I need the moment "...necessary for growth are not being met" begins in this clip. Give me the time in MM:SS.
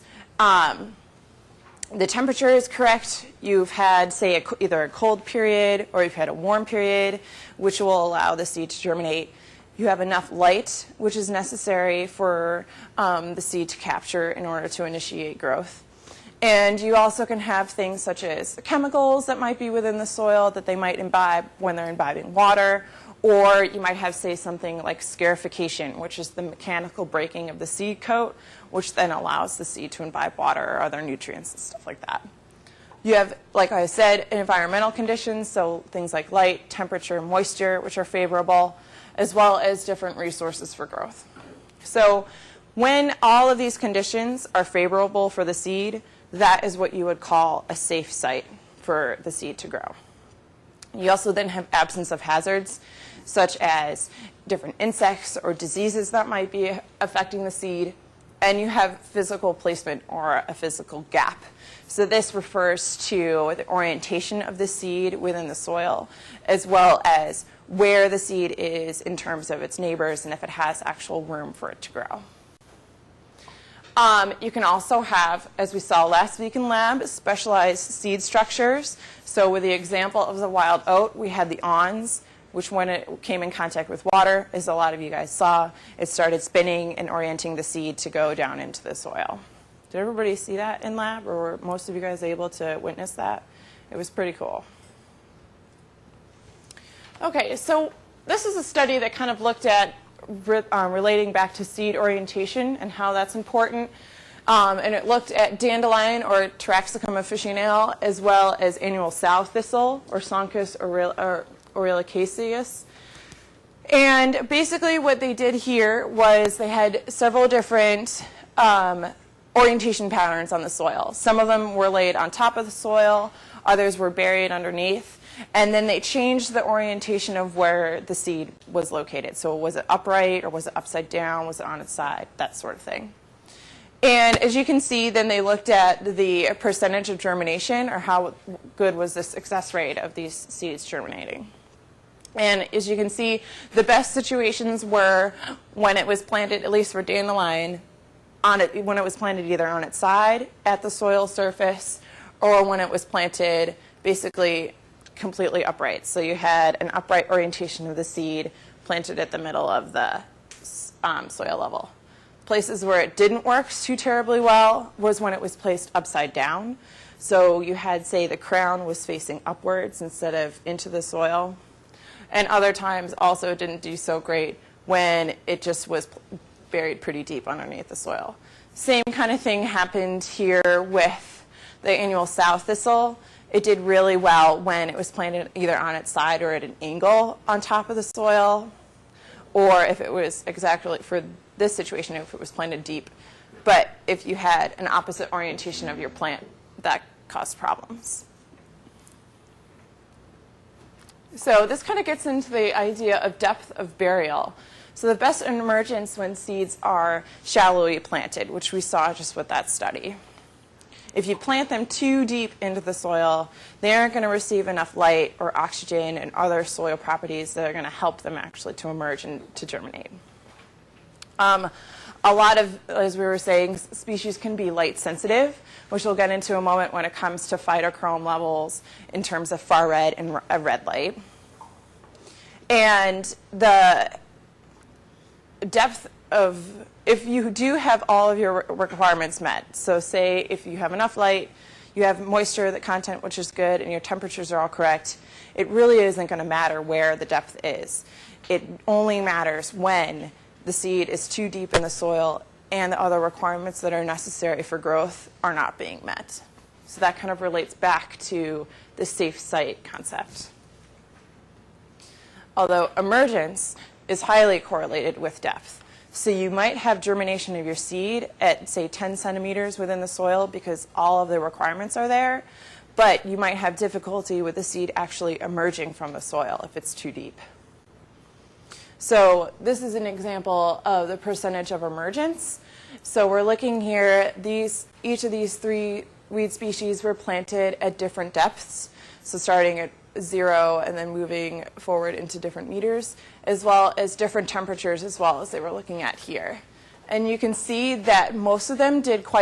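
04:14.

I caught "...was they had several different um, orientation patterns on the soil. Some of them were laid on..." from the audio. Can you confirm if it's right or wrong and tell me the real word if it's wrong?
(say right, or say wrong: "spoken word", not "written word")
right.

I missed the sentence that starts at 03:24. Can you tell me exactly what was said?
So the best emergence when seeds are shallowly planted, which we saw just with that study.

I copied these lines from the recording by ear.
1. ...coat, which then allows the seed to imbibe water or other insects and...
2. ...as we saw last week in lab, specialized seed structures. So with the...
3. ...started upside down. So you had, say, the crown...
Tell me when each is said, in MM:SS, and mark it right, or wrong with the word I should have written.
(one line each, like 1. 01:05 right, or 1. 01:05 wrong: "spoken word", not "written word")
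1. 00:28 wrong: "nutrients", not "insects"
2. 01:15 right
3. 02:45 wrong: "placed", not "started".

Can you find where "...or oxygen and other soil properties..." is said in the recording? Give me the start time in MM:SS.
03:35.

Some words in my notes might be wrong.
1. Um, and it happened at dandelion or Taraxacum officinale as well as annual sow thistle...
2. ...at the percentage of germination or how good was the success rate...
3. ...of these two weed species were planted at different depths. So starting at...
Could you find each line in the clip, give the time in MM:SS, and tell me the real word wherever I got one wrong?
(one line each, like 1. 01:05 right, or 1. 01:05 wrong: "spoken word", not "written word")
1. 01:44 wrong: "looked", not "happened"
2. 02:15 right
3. 04:45 wrong: "three", not "two".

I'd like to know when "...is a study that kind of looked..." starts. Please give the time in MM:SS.
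01:38.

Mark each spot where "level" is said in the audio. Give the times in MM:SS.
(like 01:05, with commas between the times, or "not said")
02:41, 03:48.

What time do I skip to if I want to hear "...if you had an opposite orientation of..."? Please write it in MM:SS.
03:14.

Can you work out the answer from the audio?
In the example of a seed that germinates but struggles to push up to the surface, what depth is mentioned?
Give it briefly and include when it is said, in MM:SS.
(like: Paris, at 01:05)
10 centimeters, at 04:28.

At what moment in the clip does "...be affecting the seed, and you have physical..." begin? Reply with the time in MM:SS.
00:56.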